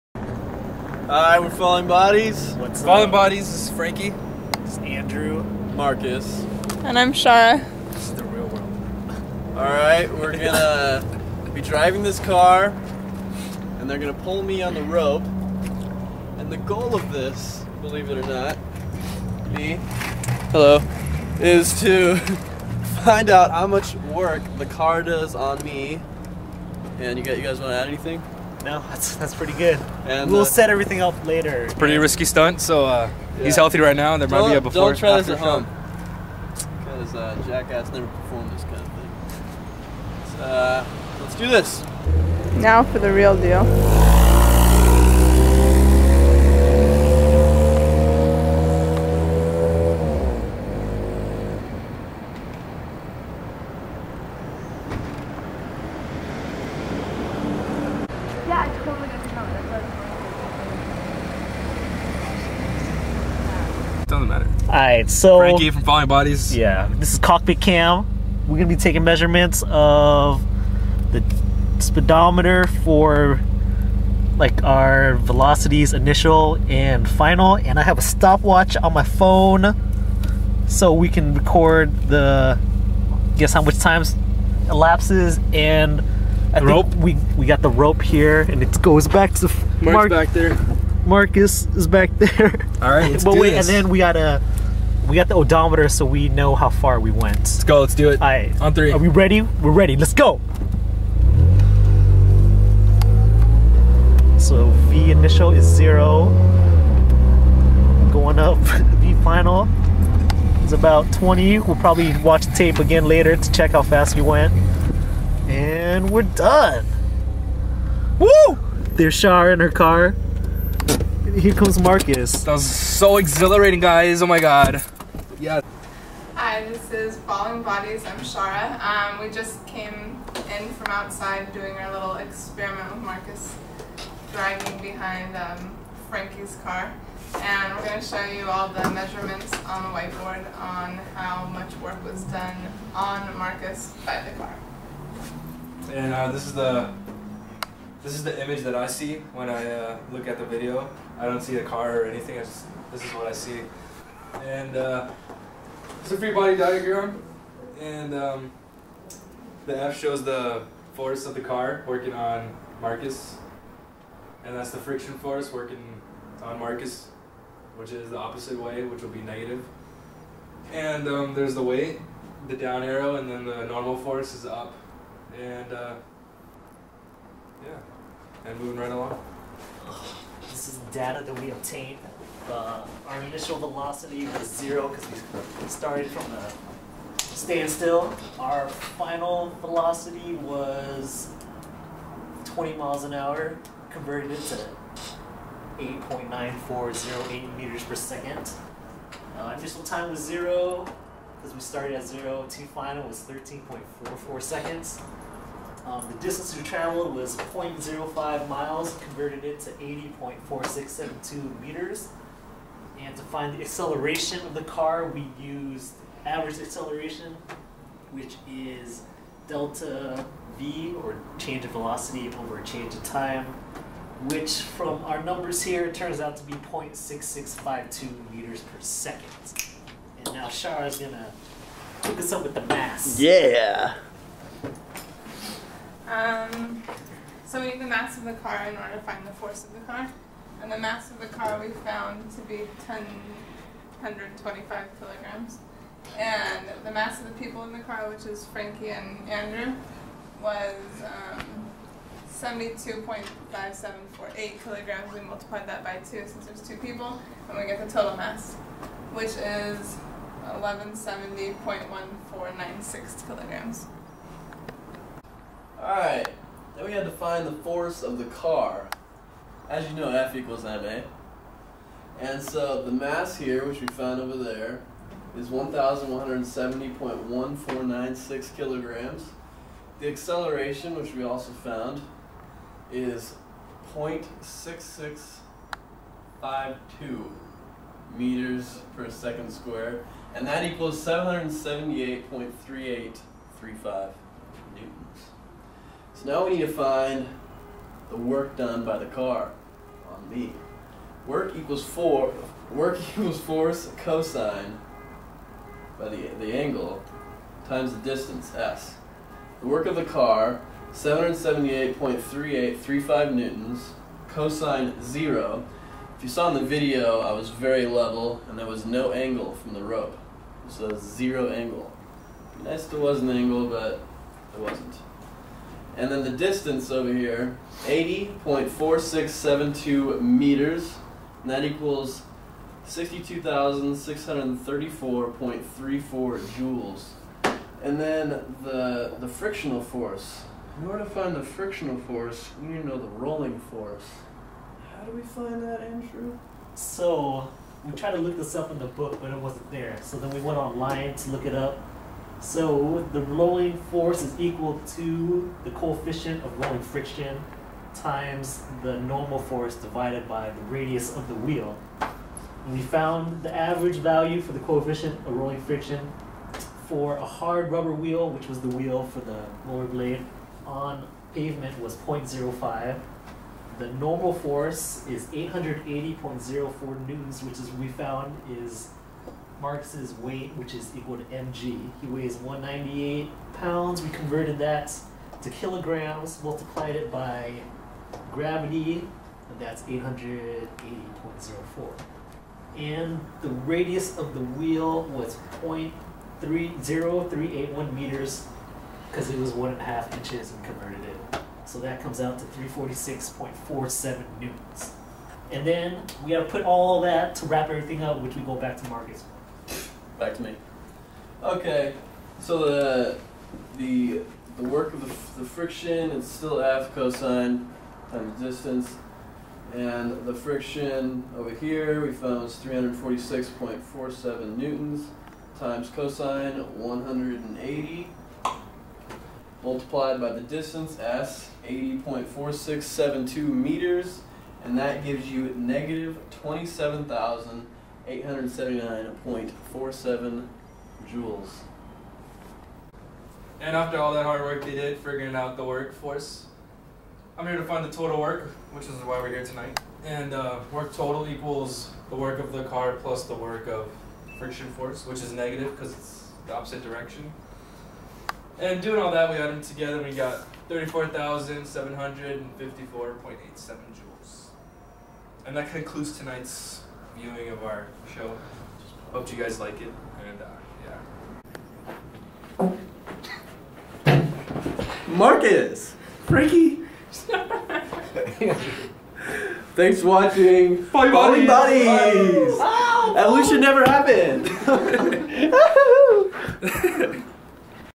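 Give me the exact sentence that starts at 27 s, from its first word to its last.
And you guys, you guys want to add anything?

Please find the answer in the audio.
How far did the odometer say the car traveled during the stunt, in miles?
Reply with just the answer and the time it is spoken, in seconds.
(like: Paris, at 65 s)
0.05 miles, at 207 s.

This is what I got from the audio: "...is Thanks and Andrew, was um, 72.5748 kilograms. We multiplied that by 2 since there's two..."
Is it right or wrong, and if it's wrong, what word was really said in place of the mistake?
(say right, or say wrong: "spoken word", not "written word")
wrong: "Frankie", not "Thanks".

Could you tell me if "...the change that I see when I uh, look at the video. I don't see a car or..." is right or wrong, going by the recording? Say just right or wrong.
wrong.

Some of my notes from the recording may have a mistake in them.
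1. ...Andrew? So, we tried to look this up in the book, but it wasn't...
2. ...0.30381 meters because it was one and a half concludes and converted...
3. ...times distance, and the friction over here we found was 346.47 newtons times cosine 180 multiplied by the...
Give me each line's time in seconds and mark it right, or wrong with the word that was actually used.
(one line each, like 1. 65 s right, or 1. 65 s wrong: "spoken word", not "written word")
1. 345 s right
2. 395 s wrong: "inches", not "concludes"
3. 418 s right.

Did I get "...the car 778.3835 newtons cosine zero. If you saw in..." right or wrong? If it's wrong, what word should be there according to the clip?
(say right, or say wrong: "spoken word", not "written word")
right.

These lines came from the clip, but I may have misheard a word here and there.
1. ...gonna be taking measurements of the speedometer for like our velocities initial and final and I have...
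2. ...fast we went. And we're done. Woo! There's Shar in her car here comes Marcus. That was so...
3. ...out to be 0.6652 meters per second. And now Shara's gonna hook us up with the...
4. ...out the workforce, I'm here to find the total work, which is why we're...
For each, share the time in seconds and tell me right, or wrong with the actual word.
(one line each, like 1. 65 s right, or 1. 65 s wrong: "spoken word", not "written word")
1. 68 s right
2. 113 s right
3. 226 s right
4. 445 s right.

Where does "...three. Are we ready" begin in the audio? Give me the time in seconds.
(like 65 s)
98 s.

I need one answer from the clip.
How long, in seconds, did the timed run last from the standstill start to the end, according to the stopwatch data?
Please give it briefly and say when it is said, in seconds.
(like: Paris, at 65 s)
13.44 seconds, at 203 s.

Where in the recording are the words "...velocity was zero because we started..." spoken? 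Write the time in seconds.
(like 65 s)
183 s.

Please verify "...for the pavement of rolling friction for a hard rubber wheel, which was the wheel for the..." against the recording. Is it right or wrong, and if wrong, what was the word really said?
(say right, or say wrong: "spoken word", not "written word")
wrong: "coefficient", not "pavement".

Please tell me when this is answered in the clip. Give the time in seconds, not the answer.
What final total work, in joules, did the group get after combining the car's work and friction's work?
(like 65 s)
460 s.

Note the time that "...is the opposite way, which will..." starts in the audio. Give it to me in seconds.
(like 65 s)
167 s.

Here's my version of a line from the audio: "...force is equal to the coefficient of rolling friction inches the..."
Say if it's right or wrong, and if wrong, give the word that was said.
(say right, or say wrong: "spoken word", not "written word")
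wrong: "times", not "inches".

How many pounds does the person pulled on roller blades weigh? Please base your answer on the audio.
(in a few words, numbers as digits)
198 pounds.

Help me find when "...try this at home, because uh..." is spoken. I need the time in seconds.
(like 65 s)
34 s.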